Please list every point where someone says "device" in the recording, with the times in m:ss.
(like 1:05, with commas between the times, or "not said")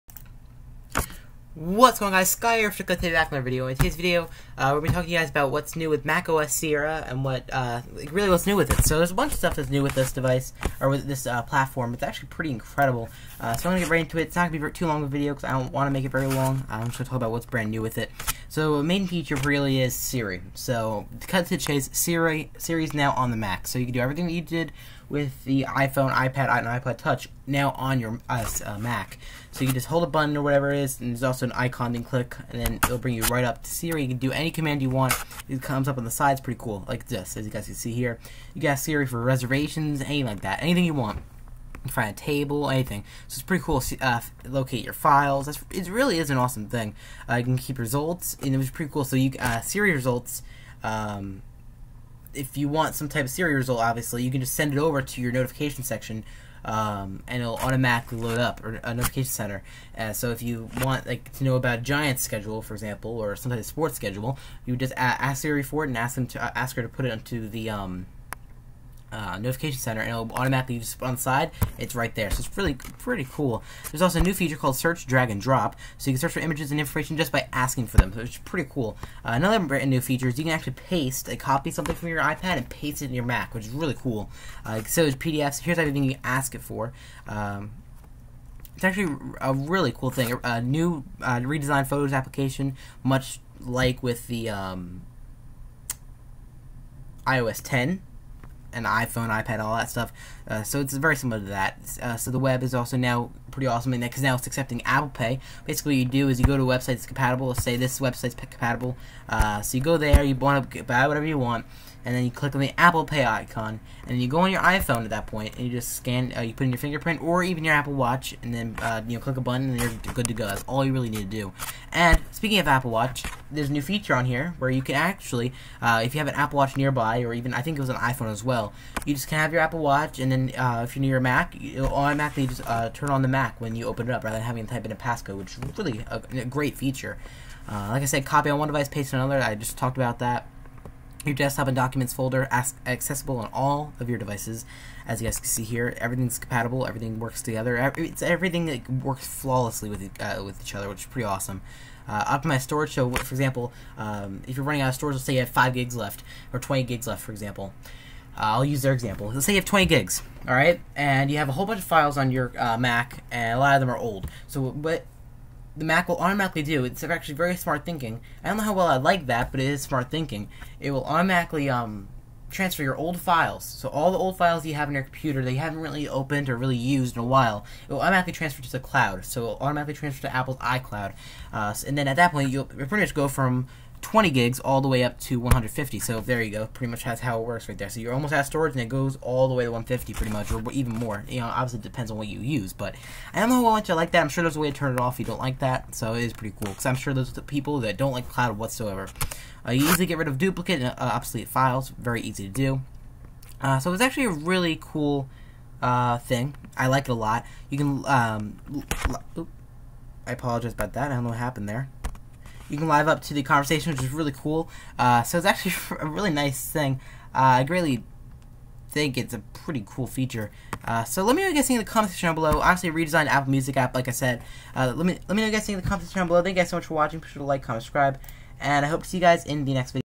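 0:10, 2:18, 2:24.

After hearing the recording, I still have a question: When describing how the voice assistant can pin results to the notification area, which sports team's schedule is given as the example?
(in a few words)
Giants.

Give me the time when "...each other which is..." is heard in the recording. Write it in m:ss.
2:30.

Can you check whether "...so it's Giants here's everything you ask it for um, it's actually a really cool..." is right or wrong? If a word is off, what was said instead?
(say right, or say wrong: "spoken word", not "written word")
wrong: "PDFs", not "Giants".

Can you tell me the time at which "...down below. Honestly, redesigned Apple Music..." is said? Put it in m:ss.
3:42.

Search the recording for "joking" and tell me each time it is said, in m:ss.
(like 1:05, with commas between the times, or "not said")
not said.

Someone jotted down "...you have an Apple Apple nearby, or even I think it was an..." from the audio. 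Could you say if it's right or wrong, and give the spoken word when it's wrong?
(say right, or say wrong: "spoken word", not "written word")
wrong: "Watch", not "Apple".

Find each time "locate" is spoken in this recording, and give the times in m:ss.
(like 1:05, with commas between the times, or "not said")
0:44.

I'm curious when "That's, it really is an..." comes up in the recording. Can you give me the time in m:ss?
0:45.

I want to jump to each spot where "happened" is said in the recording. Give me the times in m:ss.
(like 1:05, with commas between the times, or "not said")
3:31.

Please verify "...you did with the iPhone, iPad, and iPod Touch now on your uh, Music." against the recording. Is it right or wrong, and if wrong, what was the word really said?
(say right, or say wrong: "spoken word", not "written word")
wrong: "Mac", not "Music".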